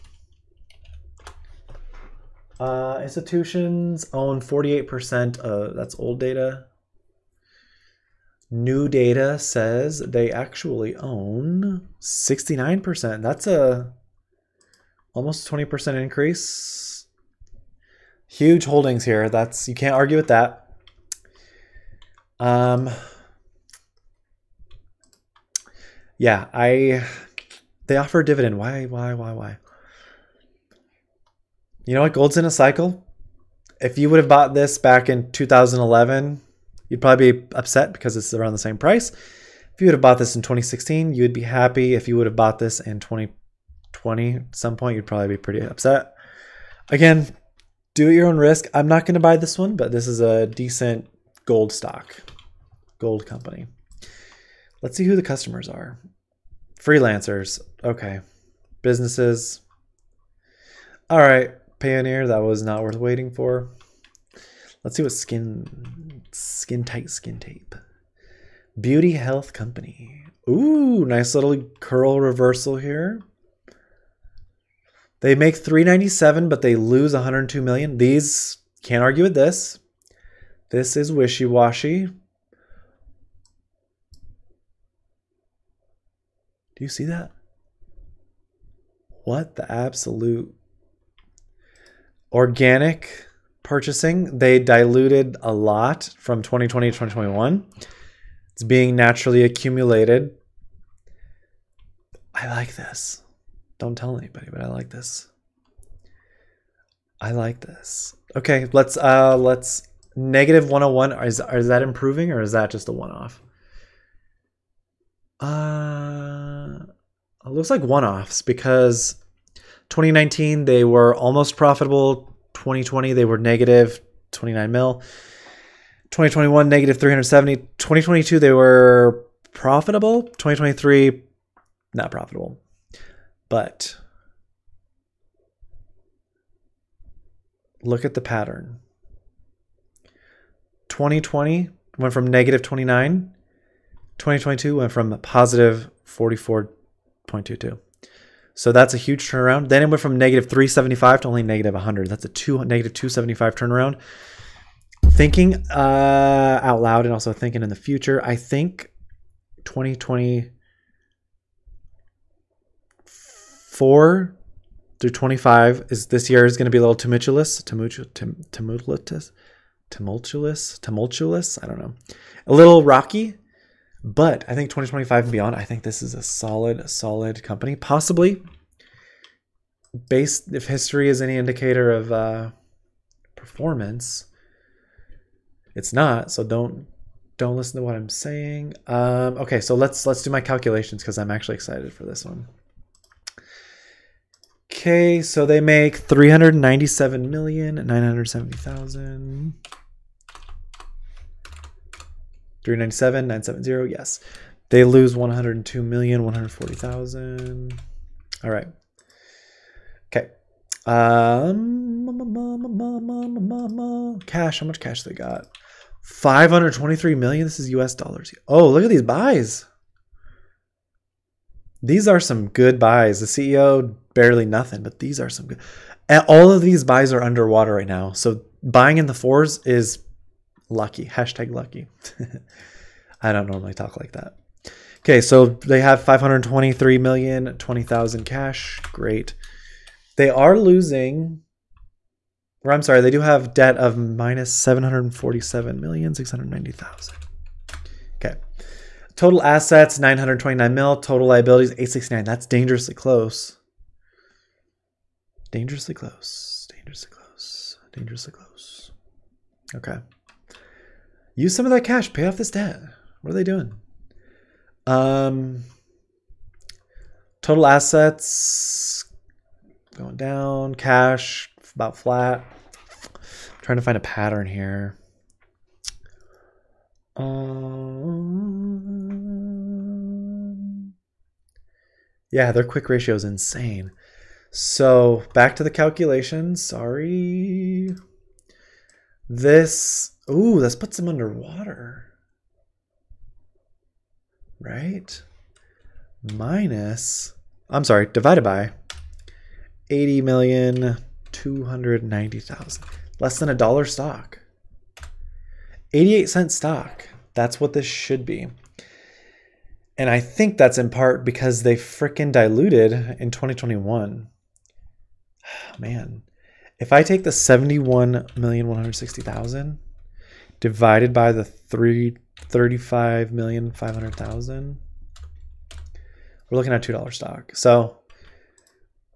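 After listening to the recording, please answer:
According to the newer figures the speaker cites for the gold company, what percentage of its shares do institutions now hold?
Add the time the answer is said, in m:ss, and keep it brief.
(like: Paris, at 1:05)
69%, at 0:11.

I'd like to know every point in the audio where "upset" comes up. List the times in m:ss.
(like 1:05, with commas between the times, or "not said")
0:37, 0:45.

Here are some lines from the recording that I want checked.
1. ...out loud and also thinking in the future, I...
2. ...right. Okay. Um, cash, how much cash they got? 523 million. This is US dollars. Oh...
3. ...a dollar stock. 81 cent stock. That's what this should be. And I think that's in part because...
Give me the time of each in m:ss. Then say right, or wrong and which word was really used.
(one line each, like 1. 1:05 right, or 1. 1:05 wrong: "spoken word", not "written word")
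1. 2:36 right
2. 3:28 right
3. 5:03 wrong: "88", not "81".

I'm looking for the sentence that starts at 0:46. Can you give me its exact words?
Again, do it your own risk.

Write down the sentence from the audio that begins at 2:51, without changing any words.
I don't know, a little rocky but I think 2025 and beyond, I think this is a solid, solid company.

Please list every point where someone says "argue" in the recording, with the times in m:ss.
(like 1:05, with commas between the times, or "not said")
0:19, 1:19.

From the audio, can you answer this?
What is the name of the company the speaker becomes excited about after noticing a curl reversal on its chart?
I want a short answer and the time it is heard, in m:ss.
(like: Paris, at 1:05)
Beauty Health Company, at 1:08.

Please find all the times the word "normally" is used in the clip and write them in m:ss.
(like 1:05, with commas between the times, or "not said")
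3:53.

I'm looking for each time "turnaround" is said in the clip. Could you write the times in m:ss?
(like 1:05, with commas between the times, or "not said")
2:29, 2:33.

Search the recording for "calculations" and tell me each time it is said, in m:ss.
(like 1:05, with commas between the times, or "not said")
3:10, 4:45.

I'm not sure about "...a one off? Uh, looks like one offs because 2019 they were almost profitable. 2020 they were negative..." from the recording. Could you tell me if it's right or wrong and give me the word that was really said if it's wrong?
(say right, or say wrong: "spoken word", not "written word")
right.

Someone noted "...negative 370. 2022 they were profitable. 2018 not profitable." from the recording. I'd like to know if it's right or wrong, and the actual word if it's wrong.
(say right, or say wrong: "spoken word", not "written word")
wrong: "2023", not "2018".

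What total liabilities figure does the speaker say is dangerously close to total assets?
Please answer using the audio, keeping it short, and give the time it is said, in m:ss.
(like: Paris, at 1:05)
869 million, at 4:11.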